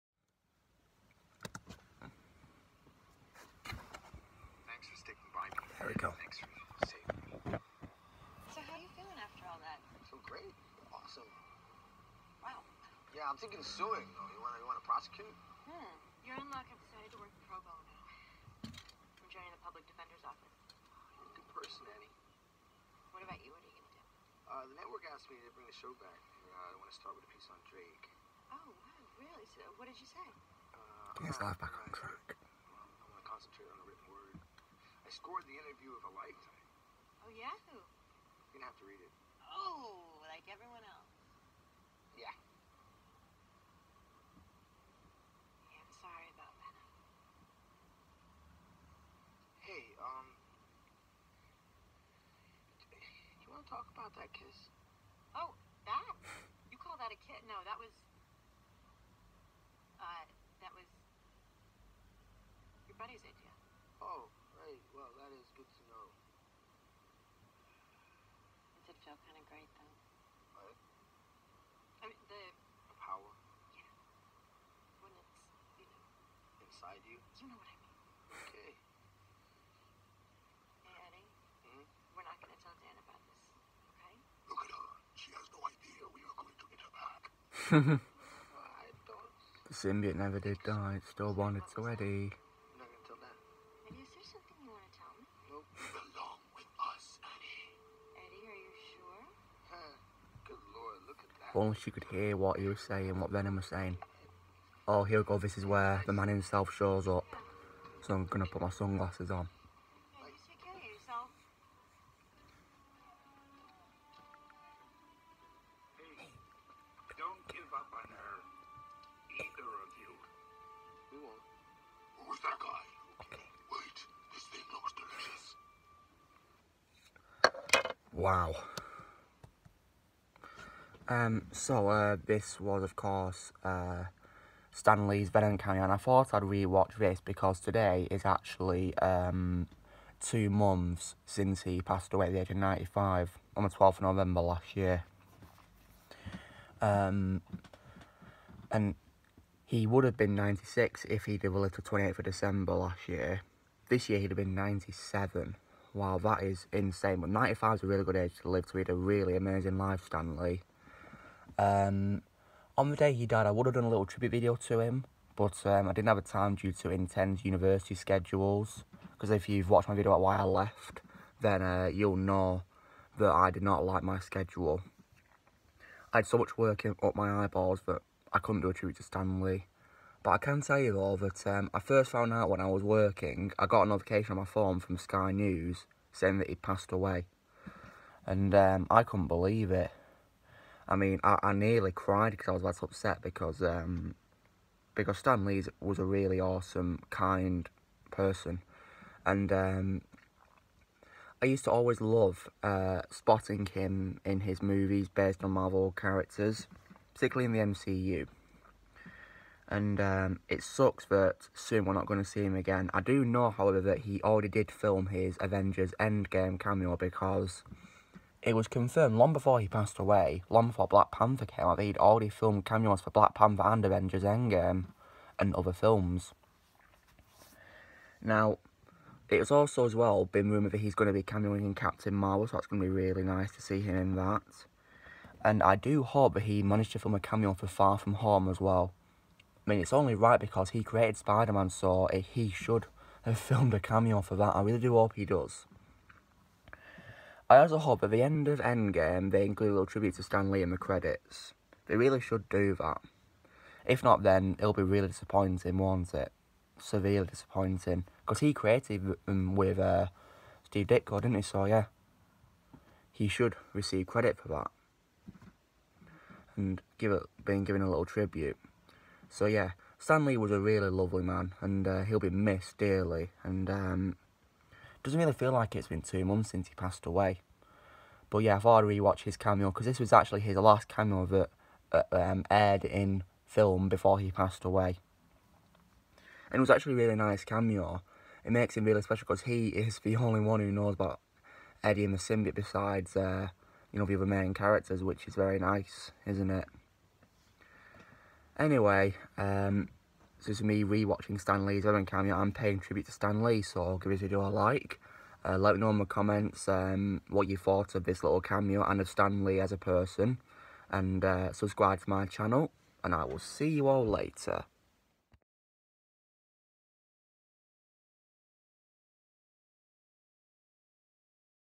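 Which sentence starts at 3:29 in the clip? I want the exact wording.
And um, it sucks that soon we're not going to see him again.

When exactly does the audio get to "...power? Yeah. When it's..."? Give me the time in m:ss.
1:12.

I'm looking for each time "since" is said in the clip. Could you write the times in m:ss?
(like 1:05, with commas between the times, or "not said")
2:21, 4:36.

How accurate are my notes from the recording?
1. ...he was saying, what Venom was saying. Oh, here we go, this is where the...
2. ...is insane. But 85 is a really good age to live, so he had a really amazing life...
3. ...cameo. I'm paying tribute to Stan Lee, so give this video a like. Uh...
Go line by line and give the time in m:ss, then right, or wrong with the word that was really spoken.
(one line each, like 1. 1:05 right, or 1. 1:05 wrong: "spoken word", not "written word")
1. 1:42 right
2. 2:36 wrong: "95", not "85"
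3. 5:02 right.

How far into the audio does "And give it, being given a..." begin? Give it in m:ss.
4:26.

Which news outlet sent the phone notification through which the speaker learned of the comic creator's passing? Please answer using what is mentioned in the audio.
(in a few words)
Sky News.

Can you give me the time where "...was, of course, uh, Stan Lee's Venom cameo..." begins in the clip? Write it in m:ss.
2:12.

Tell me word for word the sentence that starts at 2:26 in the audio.
Um, and he would have been 96 if he'd have lived to 28th of December last year.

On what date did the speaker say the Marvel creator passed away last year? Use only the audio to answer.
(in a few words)
12th of November.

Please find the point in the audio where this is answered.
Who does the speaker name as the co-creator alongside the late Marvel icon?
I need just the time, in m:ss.
4:20.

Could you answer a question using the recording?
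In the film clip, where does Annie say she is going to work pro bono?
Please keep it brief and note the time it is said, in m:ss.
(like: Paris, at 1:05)
Public defender's office, at 0:19.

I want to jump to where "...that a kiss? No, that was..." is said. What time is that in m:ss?
0:57.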